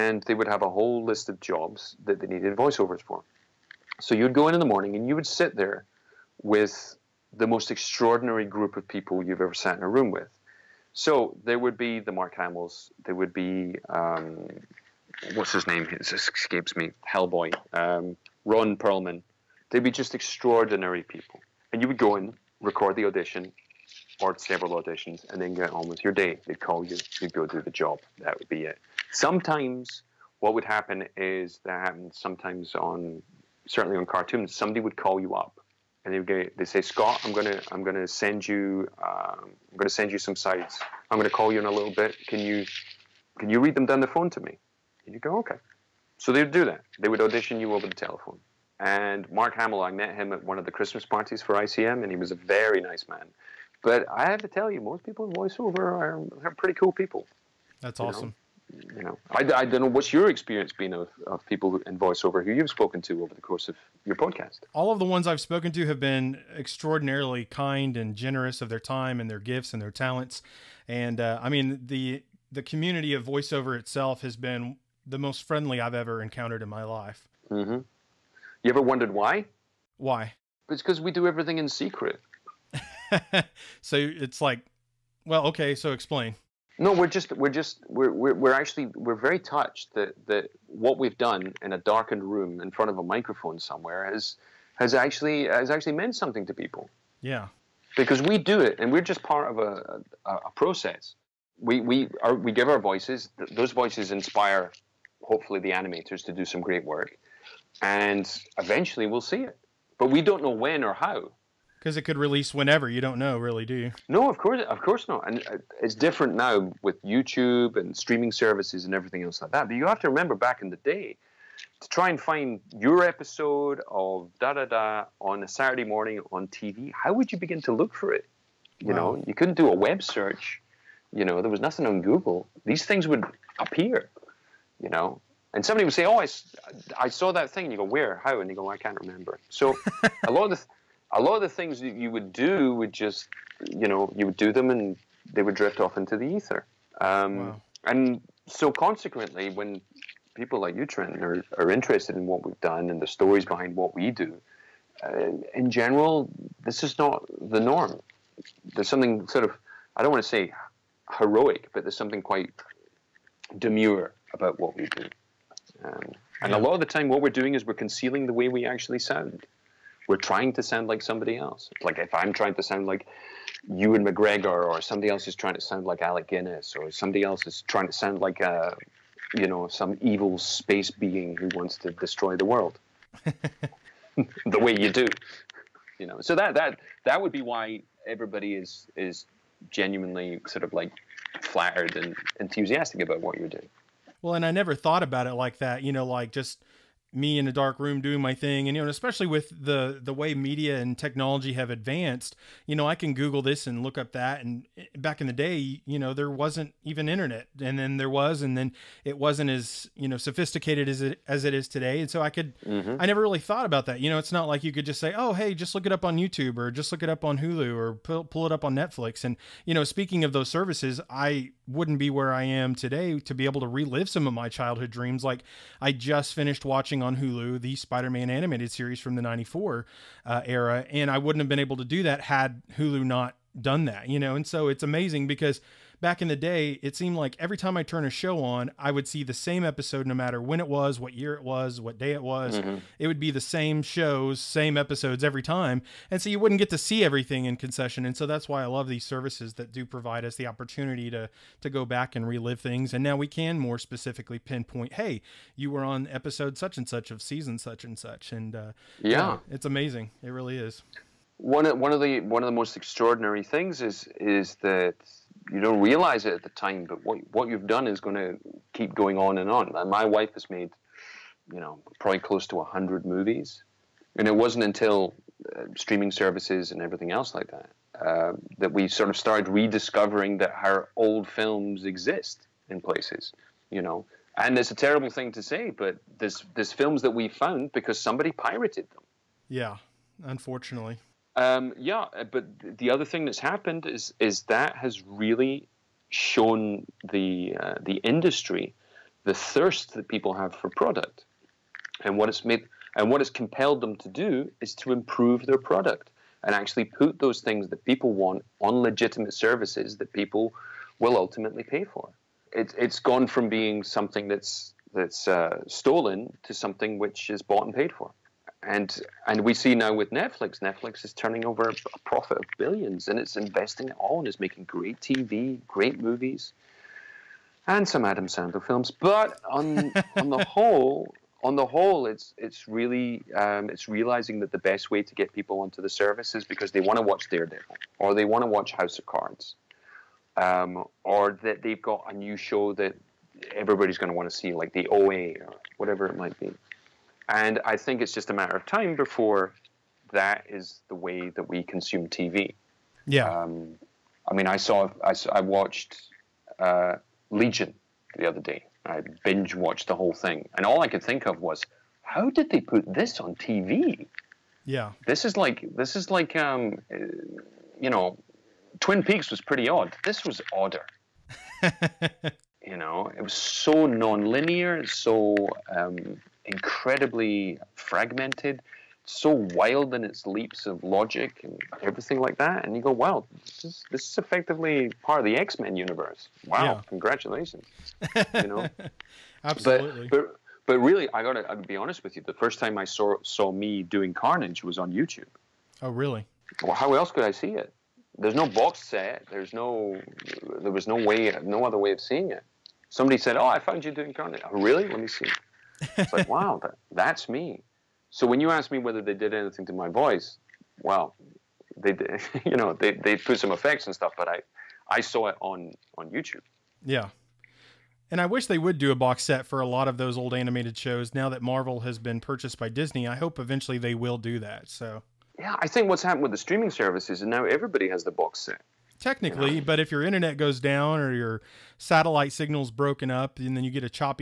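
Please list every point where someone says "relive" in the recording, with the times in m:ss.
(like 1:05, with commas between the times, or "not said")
3:43, 4:12.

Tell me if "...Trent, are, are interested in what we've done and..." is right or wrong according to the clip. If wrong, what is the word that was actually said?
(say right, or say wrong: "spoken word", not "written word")
right.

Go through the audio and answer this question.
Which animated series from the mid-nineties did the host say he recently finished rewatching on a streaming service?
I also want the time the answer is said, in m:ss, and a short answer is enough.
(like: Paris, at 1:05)
Spider-Man, at 3:47.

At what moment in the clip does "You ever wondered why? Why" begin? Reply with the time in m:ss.
1:18.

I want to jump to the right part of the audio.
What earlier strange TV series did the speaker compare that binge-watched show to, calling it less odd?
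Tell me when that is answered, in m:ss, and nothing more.
6:08.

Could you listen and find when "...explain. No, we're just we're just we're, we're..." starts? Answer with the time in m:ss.
1:25.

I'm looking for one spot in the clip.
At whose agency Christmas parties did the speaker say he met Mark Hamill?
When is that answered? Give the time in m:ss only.
0:51.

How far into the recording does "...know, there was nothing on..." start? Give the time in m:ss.
2:11.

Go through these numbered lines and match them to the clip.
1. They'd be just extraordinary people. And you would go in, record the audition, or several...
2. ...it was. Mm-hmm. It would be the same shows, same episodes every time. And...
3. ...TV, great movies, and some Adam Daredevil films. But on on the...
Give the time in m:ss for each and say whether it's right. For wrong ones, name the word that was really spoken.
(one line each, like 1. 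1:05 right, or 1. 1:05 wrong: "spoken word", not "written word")
1. 0:19 right
2. 4:02 right
3. 5:25 wrong: "Sandler", not "Daredevil".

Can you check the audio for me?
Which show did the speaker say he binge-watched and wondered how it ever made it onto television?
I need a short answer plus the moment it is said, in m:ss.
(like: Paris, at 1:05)
Legion, at 5:57.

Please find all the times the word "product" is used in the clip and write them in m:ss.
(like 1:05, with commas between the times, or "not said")
5:00, 5:05.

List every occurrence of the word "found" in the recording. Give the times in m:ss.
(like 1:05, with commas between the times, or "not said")
4:47, 6:43.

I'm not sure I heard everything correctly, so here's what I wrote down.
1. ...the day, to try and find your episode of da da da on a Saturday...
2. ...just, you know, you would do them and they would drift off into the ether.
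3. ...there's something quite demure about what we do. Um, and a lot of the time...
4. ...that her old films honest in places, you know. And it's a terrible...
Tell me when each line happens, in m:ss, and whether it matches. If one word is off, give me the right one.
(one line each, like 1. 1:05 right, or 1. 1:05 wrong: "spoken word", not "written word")
1. 2:00 right
2. 2:22 right
3. 2:41 right
4. 4:40 wrong: "exist", not "honest".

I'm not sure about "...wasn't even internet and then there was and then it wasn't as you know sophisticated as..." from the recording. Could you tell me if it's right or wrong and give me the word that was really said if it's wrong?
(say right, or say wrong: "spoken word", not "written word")
right.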